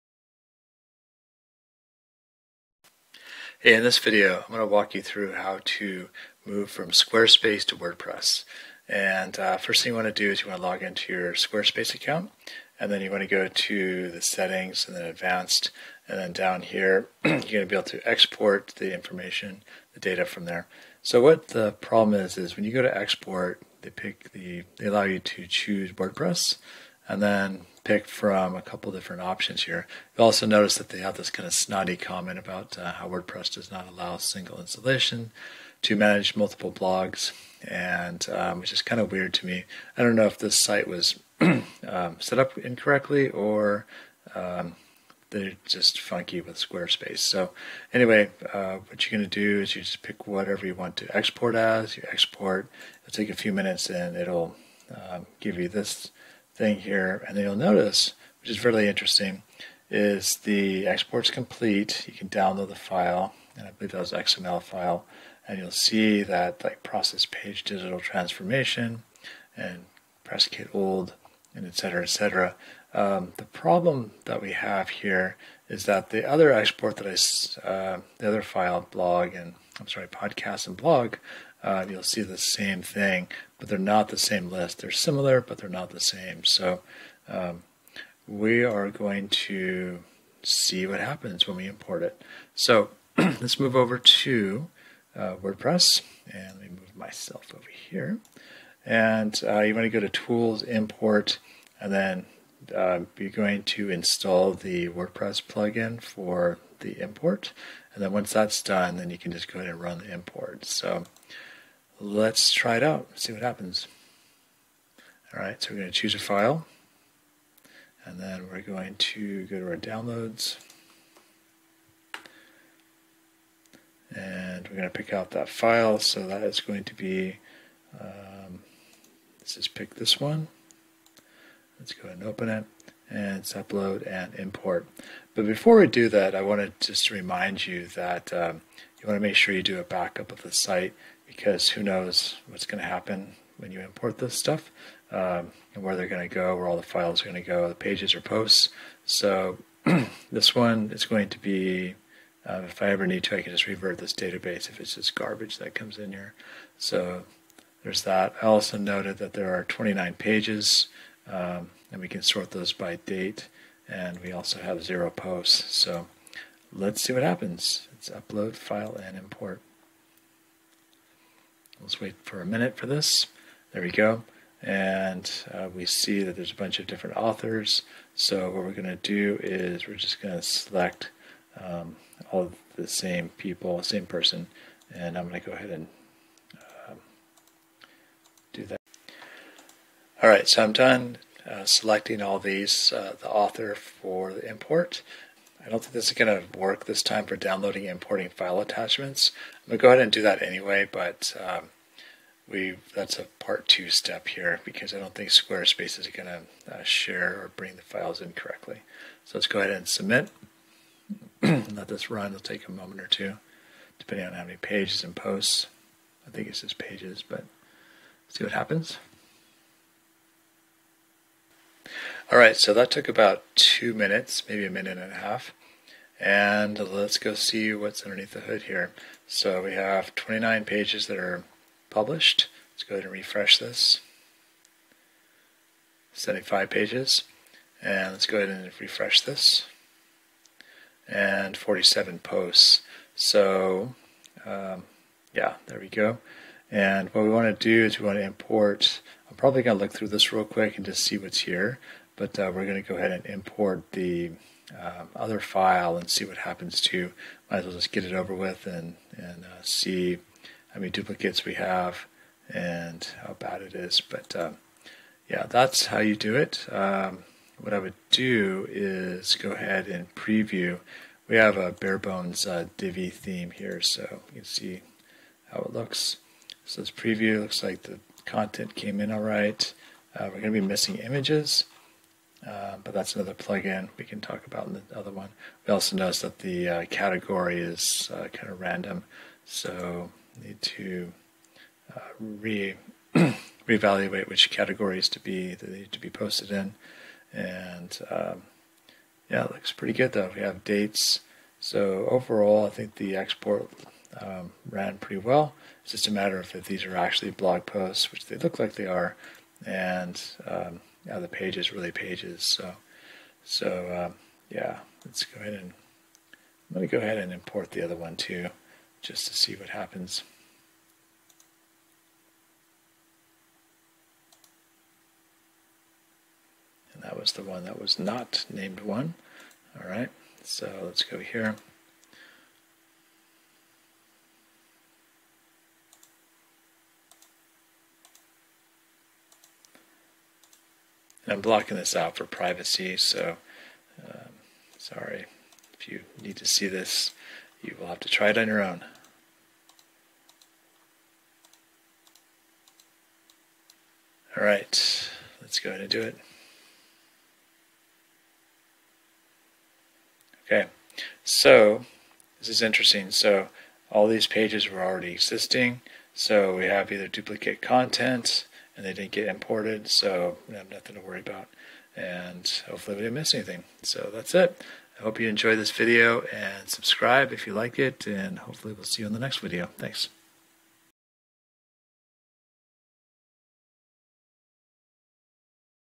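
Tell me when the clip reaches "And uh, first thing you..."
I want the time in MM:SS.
00:08.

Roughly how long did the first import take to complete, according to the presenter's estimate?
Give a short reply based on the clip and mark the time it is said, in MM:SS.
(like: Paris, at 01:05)
2 minutes, at 03:43.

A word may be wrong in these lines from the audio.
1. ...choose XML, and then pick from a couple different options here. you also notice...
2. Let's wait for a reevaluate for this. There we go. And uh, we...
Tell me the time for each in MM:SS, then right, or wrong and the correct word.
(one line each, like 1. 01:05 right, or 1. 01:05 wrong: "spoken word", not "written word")
1. 00:25 wrong: "WordPress", not "XML"
2. 02:51 wrong: "minute", not "reevaluate".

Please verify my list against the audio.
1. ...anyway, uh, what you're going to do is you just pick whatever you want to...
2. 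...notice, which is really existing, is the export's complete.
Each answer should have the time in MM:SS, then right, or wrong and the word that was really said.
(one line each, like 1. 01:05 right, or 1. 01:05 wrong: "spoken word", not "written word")
1. 00:47 right
2. 00:57 wrong: "interesting", not "existing".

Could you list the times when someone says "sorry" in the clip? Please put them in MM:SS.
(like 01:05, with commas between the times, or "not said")
01:19, 05:44.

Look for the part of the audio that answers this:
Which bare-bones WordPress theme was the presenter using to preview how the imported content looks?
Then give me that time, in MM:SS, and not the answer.
04:32.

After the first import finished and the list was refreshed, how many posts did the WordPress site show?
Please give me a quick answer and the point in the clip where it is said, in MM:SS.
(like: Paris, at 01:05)
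47, at 04:01.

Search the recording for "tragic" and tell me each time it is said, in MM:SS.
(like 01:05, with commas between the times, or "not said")
not said.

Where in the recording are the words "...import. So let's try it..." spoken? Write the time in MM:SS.
01:50.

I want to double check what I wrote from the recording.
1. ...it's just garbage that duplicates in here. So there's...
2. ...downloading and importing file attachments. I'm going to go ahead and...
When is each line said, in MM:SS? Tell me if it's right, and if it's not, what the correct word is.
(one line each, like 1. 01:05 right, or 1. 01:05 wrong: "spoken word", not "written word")
1. 02:34 wrong: "comes", not "duplicates"
2. 03:17 right.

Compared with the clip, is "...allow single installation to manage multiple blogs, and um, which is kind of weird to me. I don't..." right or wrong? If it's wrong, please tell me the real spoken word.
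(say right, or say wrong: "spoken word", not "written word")
right.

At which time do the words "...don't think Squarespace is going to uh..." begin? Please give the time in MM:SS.
03:24.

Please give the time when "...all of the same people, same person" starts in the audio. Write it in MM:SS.
03:02.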